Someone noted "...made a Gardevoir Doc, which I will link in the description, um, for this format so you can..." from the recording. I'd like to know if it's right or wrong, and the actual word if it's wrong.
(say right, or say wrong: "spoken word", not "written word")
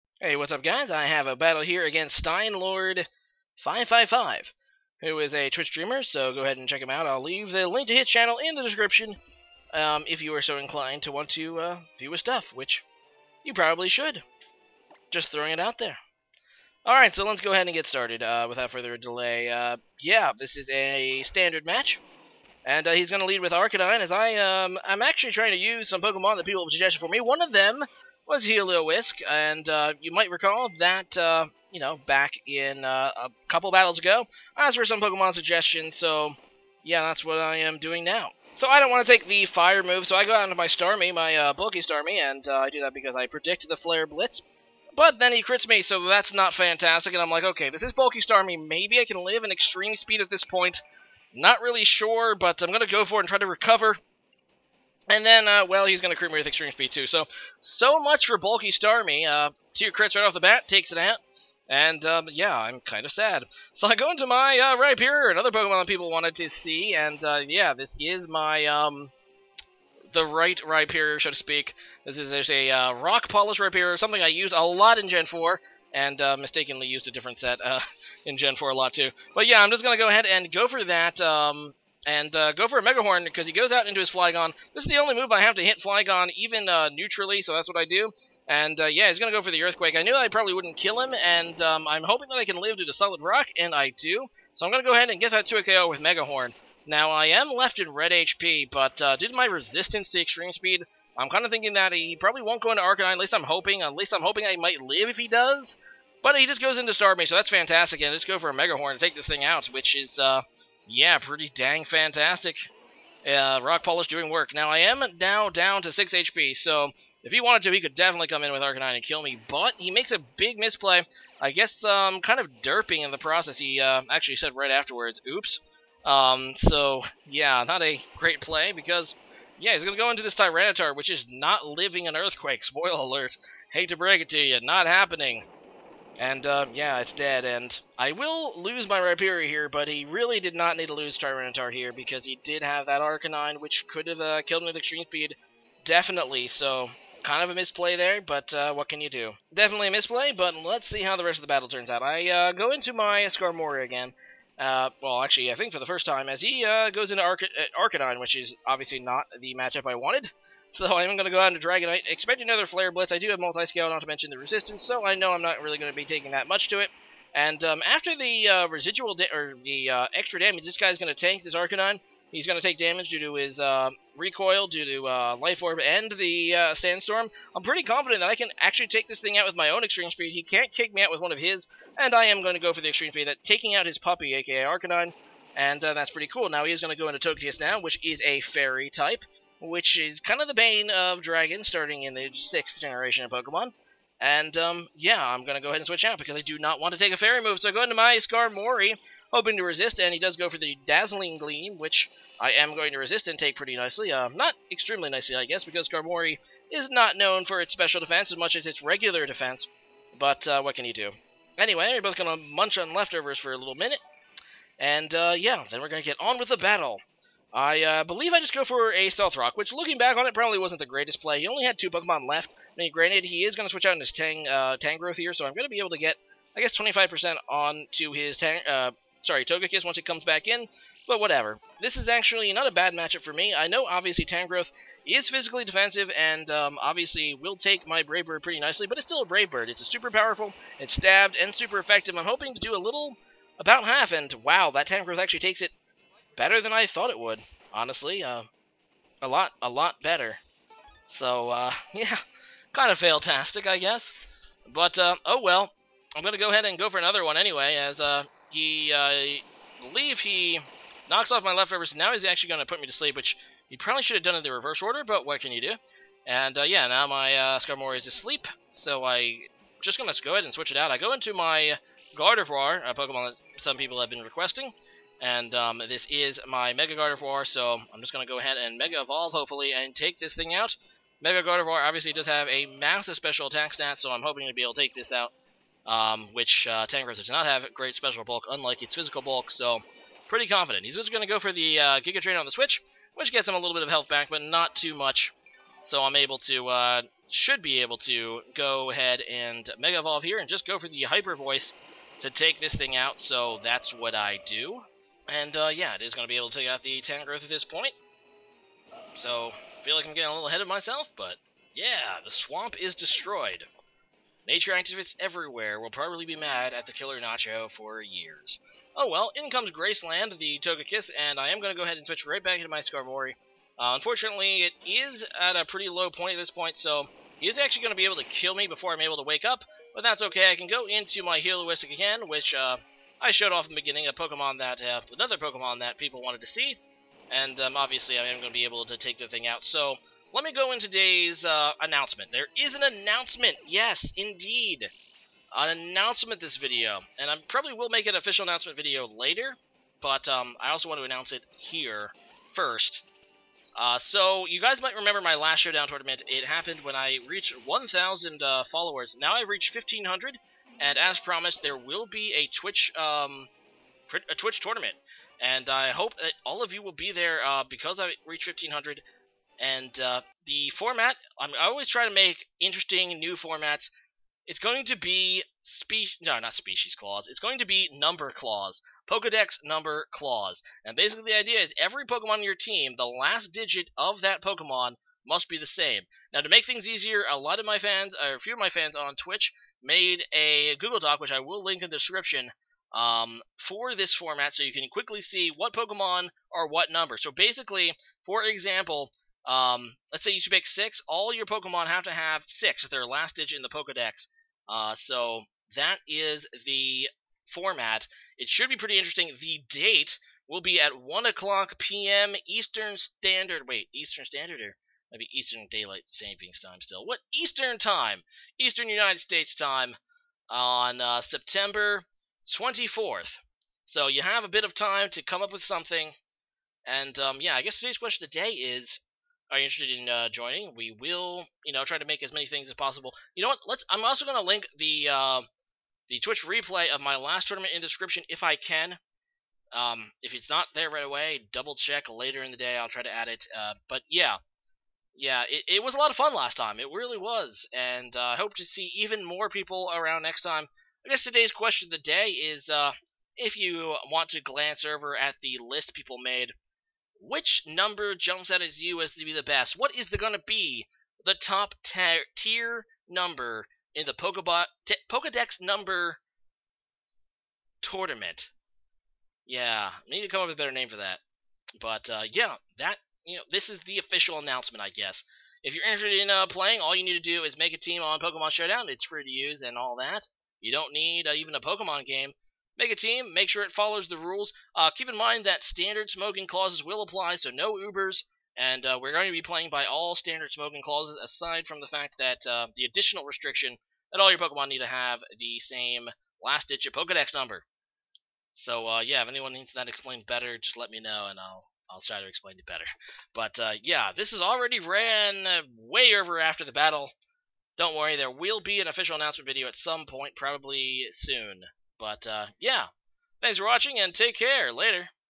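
wrong: "Google", not "Gardevoir".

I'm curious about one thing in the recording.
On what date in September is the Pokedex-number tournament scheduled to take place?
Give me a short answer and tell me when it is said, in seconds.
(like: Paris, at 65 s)
September 24th, at 422 s.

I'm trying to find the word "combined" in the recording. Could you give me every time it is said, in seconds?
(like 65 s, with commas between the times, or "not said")
not said.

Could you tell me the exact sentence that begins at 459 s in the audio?
What is going to be the top ter- tier number in the Pokebot t- Pokedex number tournament?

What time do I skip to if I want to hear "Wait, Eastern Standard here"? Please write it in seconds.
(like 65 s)
413 s.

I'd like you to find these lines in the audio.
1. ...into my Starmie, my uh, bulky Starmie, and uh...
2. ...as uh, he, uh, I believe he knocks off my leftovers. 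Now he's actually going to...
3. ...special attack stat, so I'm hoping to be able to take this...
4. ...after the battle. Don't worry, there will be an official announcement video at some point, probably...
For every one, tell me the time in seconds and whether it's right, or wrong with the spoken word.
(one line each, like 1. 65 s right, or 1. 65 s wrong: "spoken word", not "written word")
1. 40 s right
2. 257 s right
3. 283 s right
4. 506 s right.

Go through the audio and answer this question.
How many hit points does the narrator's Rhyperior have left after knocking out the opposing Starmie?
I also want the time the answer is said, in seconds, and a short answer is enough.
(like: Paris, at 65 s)
6, at 115 s.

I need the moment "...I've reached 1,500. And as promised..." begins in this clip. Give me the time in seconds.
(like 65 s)
359 s.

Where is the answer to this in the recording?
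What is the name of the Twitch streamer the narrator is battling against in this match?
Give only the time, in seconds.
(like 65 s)
2 s.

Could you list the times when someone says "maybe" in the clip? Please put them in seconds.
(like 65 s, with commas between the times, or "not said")
48 s, 415 s.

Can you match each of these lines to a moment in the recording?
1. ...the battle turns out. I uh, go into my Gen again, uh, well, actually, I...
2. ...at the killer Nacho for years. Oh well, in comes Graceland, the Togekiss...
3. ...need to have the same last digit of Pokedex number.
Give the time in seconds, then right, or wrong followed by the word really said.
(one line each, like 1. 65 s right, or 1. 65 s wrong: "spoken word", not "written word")
1. 151 s wrong: "Skarmory", not "Gen"
2. 316 s right
3. 494 s right.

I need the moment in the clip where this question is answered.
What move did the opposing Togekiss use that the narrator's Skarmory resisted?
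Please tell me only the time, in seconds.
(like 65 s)
200 s.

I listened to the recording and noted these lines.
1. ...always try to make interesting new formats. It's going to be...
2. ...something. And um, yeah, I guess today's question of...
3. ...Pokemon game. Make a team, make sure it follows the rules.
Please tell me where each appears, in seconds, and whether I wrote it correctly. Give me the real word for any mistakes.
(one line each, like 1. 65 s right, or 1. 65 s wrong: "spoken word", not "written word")
1. 371 s right
2. 425 s right
3. 481 s right.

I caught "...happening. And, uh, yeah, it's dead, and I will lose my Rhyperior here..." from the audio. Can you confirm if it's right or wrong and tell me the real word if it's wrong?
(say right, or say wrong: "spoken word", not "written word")
right.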